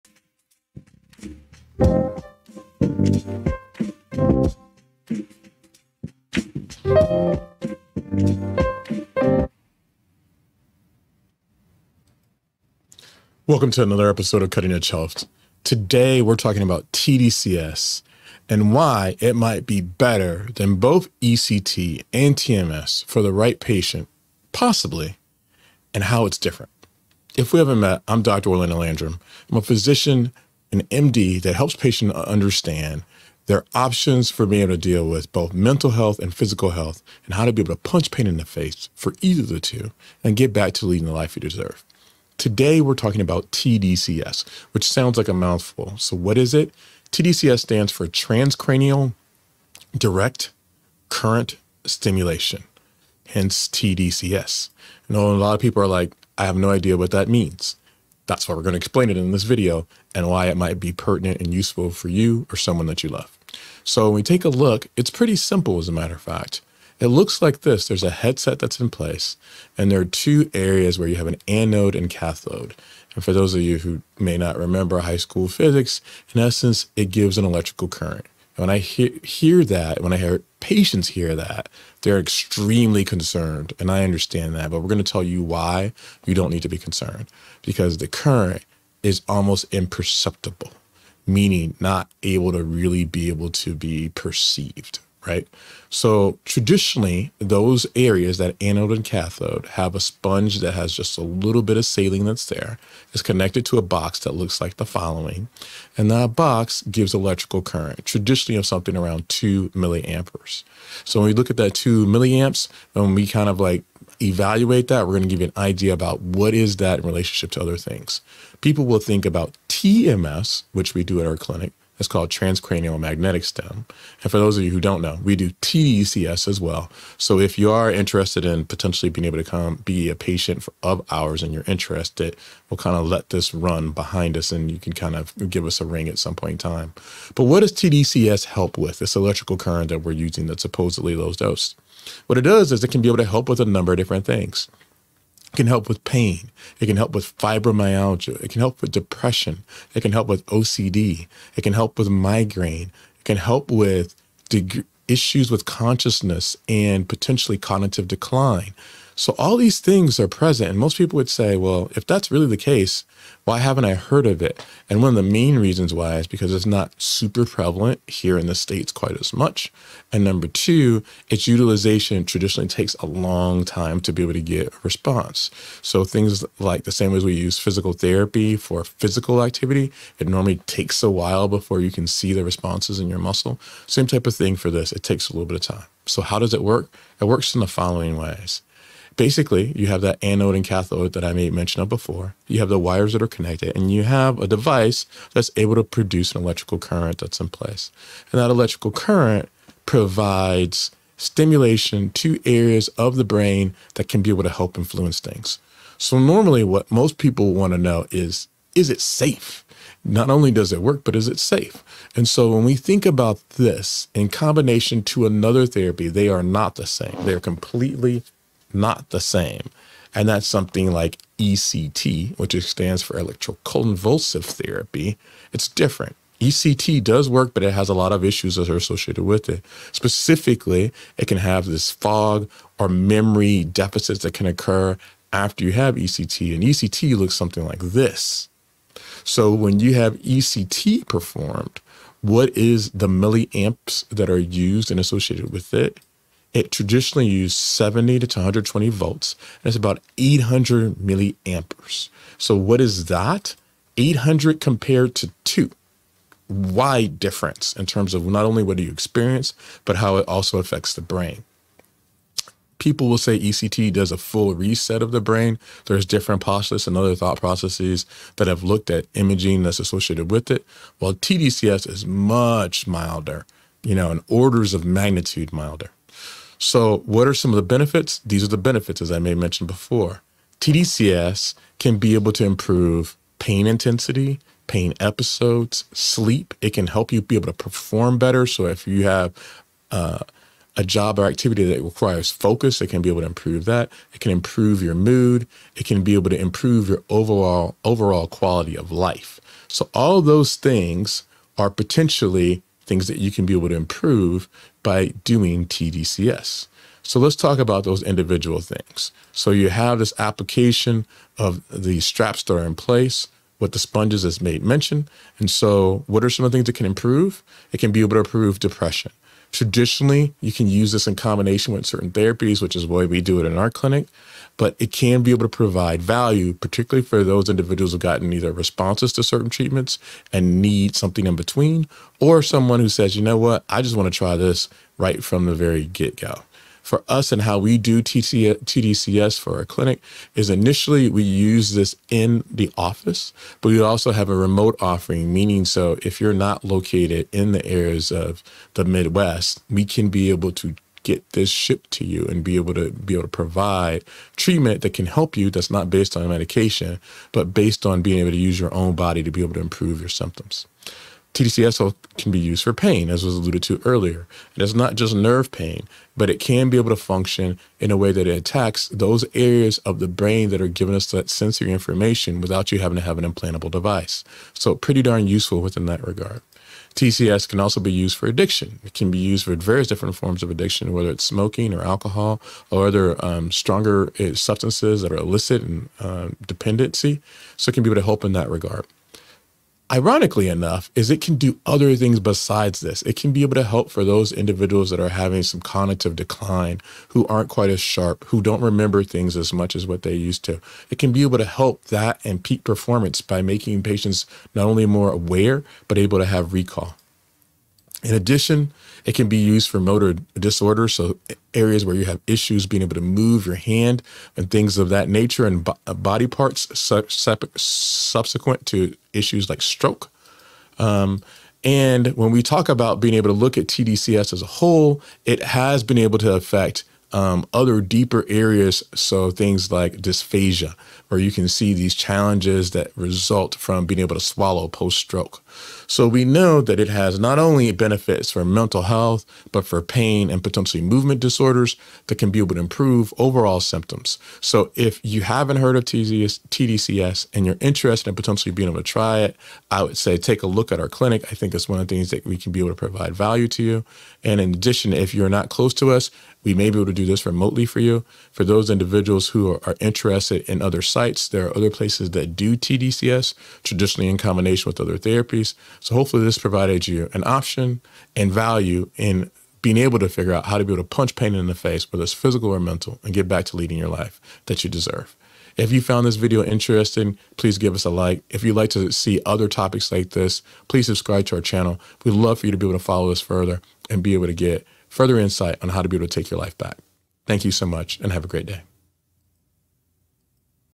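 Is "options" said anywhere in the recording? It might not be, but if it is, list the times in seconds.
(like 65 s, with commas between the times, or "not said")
33 s, 467 s.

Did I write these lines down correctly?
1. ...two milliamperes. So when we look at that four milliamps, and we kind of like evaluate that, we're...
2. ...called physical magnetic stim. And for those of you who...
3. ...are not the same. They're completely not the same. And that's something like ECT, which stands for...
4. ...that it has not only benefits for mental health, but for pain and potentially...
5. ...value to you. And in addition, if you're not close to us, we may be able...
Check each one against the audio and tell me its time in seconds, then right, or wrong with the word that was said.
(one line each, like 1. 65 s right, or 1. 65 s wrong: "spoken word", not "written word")
1. 109 s wrong: "two", not "four"
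2. 122 s wrong: "transcranial", not "physical"
3. 216 s right
4. 436 s right
5. 453 s right.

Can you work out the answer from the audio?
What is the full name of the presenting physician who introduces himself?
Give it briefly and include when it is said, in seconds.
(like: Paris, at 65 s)
Orlando Landrum, at 28 s.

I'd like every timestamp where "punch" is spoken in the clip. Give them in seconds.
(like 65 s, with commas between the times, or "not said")
37 s, 470 s.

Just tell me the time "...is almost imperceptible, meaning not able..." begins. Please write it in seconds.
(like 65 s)
89 s.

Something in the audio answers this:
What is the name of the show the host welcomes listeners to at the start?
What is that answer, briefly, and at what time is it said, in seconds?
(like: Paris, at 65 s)
Cutting Edge Health, at 14 s.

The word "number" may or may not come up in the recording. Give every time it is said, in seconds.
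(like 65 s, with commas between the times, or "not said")
143 s, 170 s.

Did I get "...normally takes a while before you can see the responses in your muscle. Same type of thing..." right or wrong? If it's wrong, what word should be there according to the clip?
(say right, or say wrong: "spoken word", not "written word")
right.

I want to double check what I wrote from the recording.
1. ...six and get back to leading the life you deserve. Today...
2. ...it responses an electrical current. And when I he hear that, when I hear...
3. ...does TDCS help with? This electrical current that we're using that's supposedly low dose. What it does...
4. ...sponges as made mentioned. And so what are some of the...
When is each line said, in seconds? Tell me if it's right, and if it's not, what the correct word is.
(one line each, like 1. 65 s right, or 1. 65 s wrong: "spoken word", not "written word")
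1. 39 s wrong: "two", not "six"
2. 76 s wrong: "gives", not "responses"
3. 137 s right
4. 313 s right.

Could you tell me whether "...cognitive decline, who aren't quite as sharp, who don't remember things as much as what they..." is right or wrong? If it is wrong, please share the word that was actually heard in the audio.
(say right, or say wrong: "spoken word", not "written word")
right.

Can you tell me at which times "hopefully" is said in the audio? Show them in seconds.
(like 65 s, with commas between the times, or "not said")
465 s.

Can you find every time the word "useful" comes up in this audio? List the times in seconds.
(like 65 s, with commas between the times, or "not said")
61 s, 375 s.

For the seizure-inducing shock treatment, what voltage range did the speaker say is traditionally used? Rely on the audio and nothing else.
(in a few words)
70 to 120 volts.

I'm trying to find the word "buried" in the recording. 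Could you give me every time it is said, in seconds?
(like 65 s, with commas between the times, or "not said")
not said.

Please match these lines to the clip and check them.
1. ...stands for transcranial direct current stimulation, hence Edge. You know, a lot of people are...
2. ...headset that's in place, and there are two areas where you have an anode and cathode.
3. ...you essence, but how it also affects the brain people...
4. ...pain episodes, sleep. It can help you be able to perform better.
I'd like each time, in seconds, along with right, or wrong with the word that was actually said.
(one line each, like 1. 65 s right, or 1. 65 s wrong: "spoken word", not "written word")
1. 47 s wrong: "TDCS", not "Edge"
2. 68 s right
3. 258 s wrong: "experience", not "essence"
4. 284 s right.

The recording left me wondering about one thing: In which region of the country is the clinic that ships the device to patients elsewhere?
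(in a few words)
Midwest.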